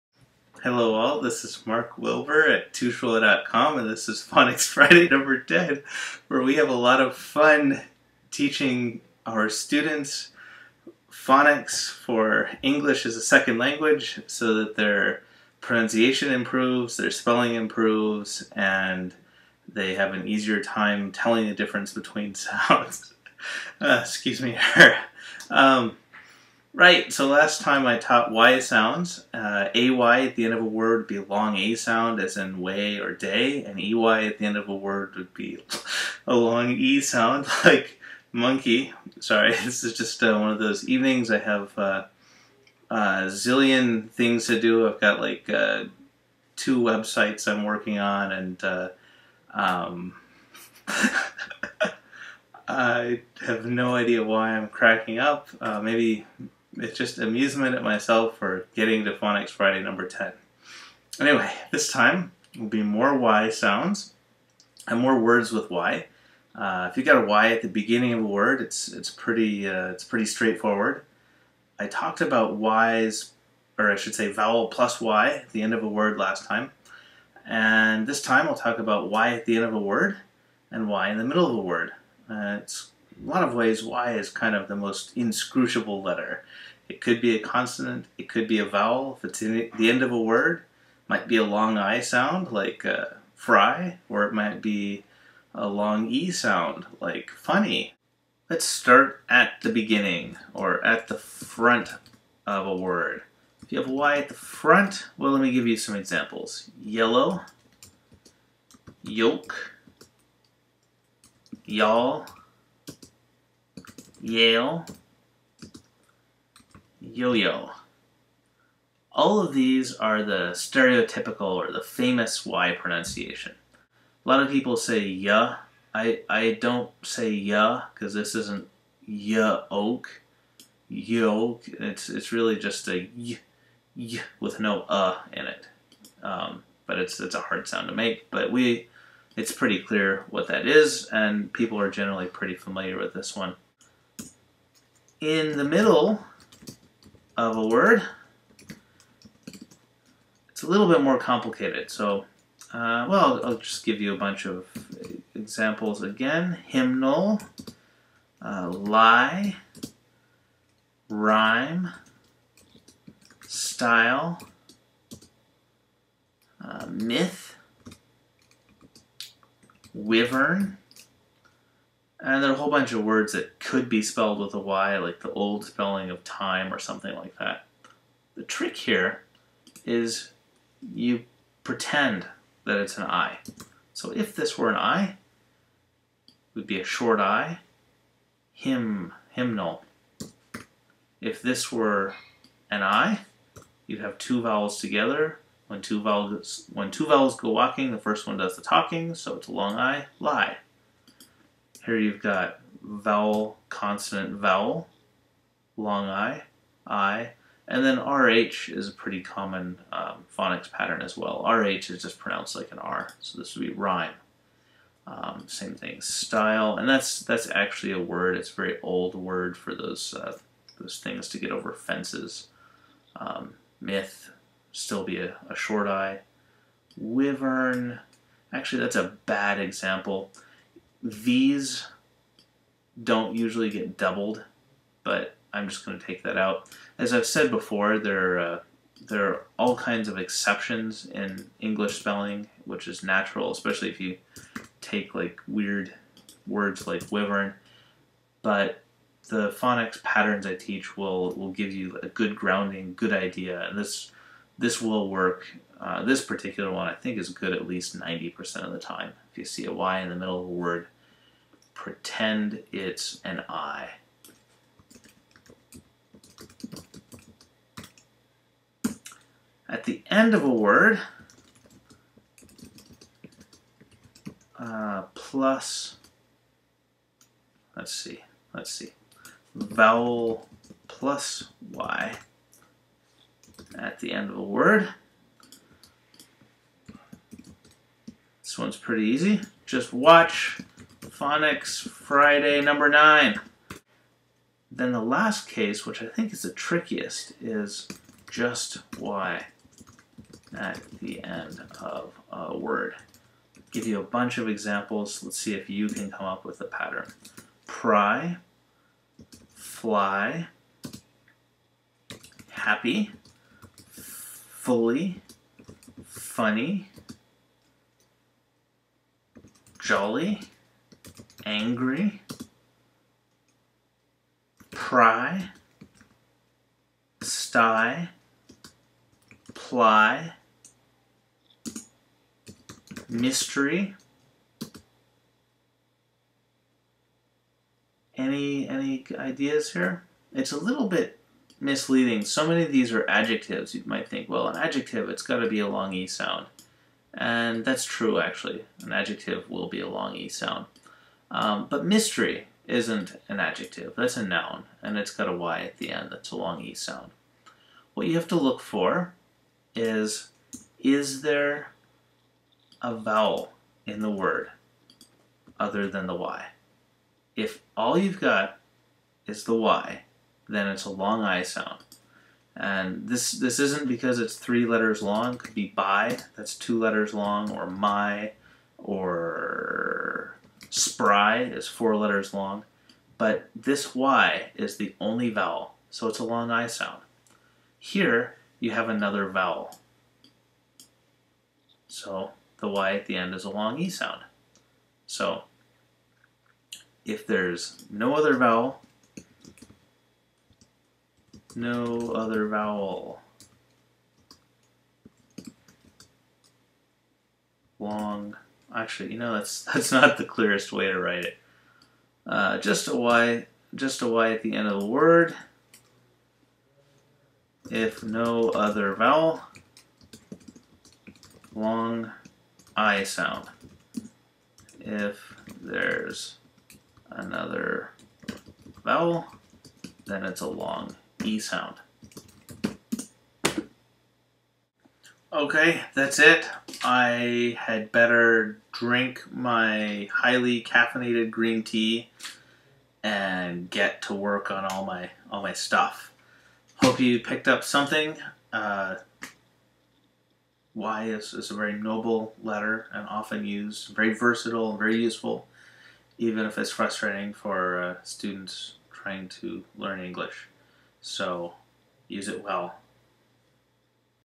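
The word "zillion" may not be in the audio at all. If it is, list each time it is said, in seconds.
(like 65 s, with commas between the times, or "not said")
43 s.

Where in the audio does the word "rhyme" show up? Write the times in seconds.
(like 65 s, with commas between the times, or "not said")
161 s, 213 s.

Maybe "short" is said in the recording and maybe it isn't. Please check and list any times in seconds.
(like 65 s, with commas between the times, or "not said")
186 s, 225 s.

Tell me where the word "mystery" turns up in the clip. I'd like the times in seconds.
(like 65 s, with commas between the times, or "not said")
333 s, 351 s.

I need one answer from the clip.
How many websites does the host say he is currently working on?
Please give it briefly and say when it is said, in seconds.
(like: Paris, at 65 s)
2, at 46 s.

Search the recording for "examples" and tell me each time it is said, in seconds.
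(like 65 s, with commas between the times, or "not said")
105 s, 155 s, 229 s, 304 s.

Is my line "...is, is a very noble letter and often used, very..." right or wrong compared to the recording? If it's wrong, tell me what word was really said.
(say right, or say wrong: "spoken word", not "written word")
right.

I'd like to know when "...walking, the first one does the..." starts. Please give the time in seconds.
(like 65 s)
197 s.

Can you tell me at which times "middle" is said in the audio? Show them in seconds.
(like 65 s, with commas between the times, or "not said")
81 s, 145 s, 260 s.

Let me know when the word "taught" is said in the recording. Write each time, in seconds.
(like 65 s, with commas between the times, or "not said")
27 s.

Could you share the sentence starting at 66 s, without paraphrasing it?
Uh, if you got a Y at the beginning of a word, it's it's pretty uh, it's pretty straightforward.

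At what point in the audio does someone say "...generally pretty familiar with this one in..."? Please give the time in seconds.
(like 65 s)
141 s.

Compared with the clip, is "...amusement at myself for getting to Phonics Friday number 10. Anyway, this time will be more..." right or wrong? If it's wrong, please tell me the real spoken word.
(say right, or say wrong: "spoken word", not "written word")
right.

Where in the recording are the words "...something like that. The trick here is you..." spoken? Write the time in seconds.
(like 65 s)
176 s.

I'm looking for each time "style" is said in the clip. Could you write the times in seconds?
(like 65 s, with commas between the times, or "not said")
163 s, 216 s.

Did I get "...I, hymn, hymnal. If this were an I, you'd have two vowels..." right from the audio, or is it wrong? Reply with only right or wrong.
right.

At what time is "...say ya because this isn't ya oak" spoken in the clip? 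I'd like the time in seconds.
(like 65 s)
127 s.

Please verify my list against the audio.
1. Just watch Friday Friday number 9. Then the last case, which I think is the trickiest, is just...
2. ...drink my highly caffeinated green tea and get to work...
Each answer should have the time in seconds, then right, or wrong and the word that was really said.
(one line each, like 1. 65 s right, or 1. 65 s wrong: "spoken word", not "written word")
1. 289 s wrong: "Phonics", not "Friday"
2. 438 s right.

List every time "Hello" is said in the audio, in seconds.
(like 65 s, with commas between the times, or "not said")
0 s.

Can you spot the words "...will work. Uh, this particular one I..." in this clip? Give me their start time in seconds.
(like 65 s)
254 s.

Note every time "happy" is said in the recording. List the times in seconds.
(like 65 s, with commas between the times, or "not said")
312 s.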